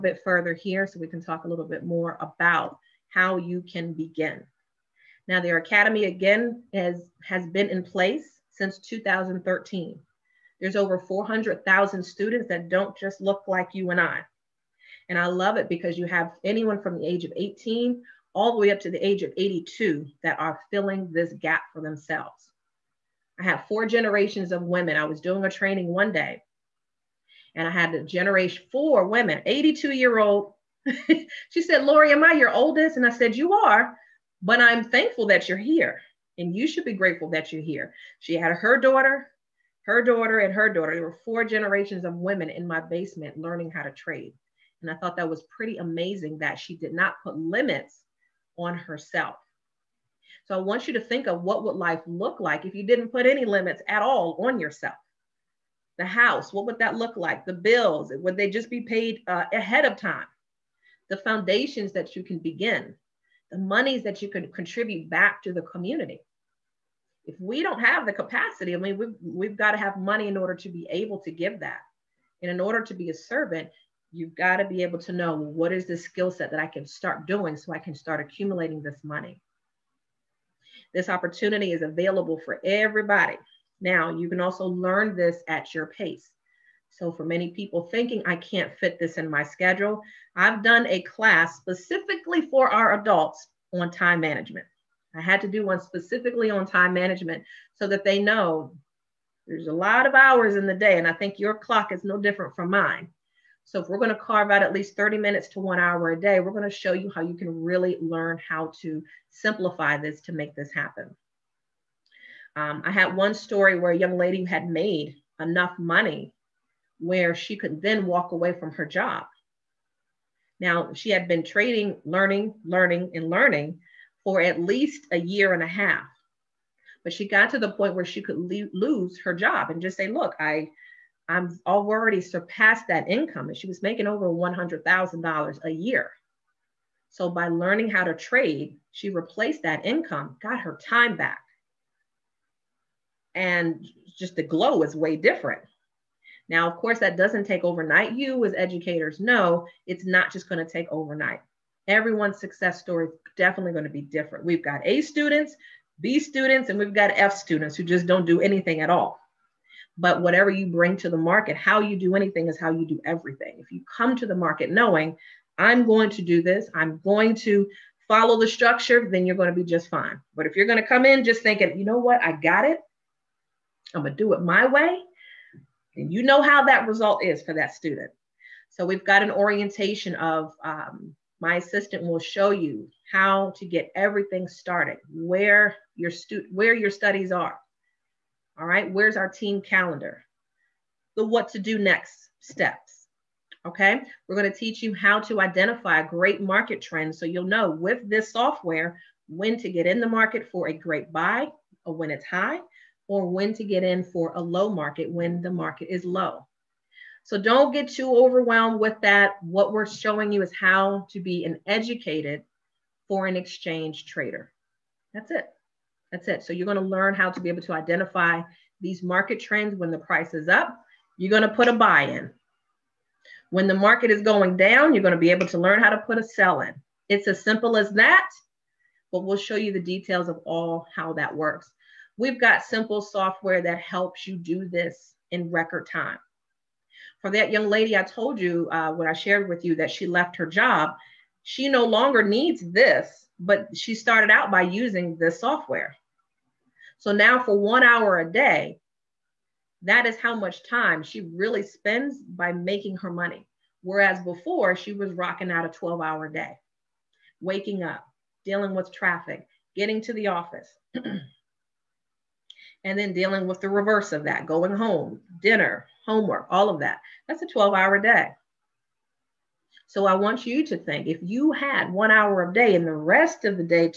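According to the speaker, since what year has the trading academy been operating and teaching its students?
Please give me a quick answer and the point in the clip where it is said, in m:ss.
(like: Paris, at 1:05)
2013, at 0:08.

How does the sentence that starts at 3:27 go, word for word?
So don't get too overwhelmed with that.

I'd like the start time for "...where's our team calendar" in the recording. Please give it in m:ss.
3:08.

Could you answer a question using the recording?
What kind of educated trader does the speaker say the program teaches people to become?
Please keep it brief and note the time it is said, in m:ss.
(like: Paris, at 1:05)
foreign exchange trader, at 3:33.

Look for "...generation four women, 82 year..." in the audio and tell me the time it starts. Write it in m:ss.
0:28.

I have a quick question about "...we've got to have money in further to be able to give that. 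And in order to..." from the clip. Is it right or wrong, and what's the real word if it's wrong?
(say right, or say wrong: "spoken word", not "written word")
wrong: "order", not "further".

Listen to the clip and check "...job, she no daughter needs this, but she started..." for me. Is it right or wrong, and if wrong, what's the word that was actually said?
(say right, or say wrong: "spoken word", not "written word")
wrong: "longer", not "daughter".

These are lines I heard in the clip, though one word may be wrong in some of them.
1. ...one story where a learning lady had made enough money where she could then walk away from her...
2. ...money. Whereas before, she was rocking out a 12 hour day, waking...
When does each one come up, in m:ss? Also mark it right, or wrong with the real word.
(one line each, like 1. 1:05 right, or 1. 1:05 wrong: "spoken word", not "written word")
1. 1:53 wrong: "young", not "learning"
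2. 4:13 right.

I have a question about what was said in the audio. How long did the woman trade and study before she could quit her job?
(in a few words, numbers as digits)
a year and a half.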